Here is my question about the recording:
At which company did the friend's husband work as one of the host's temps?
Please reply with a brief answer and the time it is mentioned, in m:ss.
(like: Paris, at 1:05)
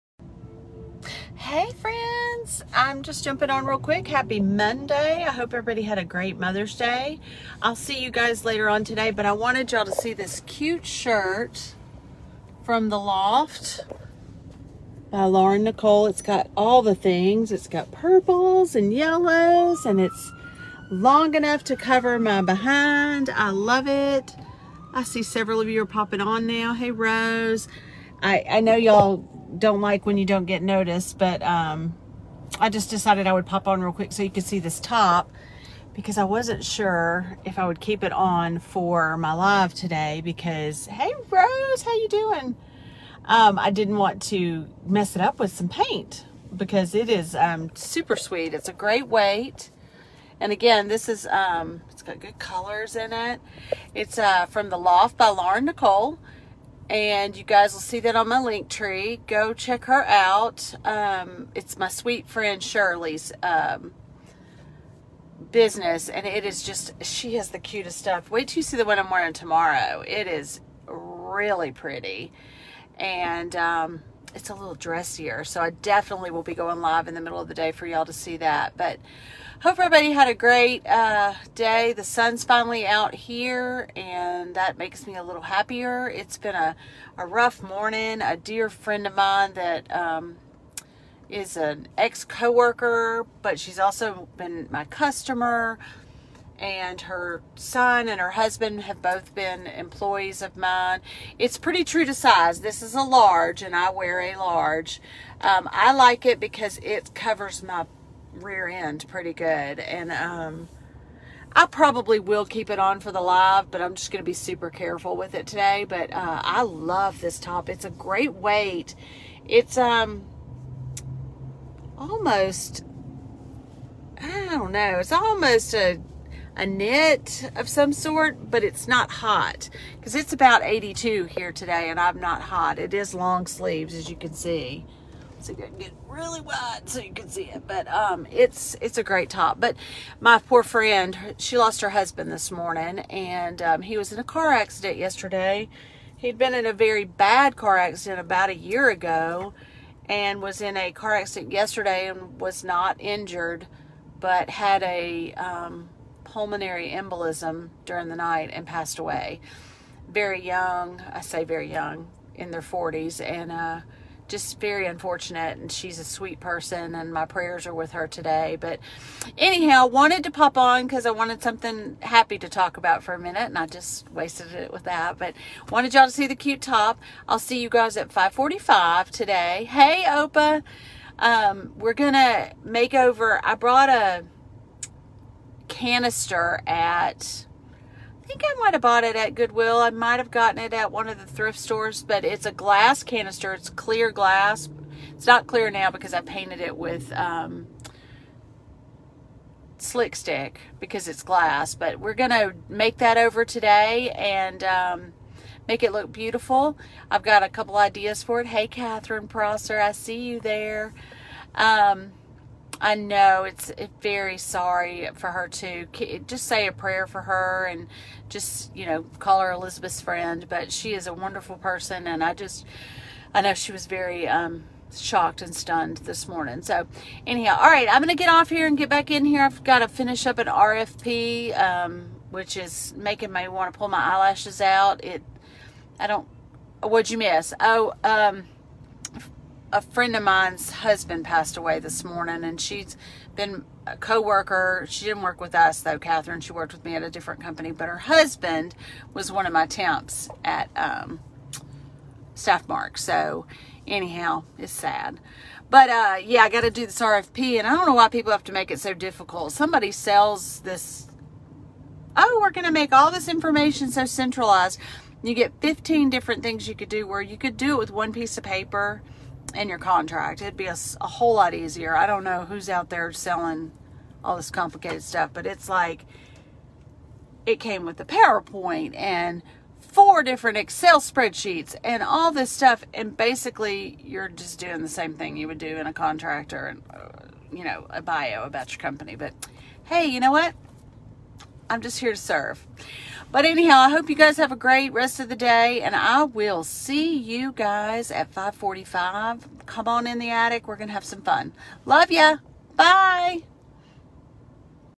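Staffmark, at 4:12.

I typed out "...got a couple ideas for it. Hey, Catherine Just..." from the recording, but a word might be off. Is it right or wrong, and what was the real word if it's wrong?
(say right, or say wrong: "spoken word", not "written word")
wrong: "Prosser", not "Just".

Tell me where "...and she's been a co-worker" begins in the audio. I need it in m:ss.
4:02.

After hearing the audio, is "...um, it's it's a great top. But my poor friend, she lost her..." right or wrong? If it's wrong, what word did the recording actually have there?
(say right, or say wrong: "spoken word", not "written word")
right.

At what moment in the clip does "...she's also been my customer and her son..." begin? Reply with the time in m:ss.
1:33.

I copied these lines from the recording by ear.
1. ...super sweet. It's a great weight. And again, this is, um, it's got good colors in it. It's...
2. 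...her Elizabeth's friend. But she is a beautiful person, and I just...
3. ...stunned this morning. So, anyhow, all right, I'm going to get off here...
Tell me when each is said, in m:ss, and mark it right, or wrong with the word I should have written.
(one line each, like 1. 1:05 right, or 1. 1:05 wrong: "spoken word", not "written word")
1. 0:47 right
2. 3:39 wrong: "wonderful", not "beautiful"
3. 3:45 right.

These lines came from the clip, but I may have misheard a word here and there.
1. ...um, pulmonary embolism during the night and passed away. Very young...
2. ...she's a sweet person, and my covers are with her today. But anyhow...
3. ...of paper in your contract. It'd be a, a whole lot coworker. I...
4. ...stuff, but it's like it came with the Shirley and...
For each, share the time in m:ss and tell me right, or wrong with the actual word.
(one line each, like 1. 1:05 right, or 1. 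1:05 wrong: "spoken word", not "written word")
1. 2:35 right
2. 2:45 wrong: "prayers", not "covers"
3. 4:28 wrong: "easier", not "coworker"
4. 4:35 wrong: "PowerPoint", not "Shirley".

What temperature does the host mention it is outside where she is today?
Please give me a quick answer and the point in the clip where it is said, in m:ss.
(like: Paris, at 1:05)
82, at 2:10.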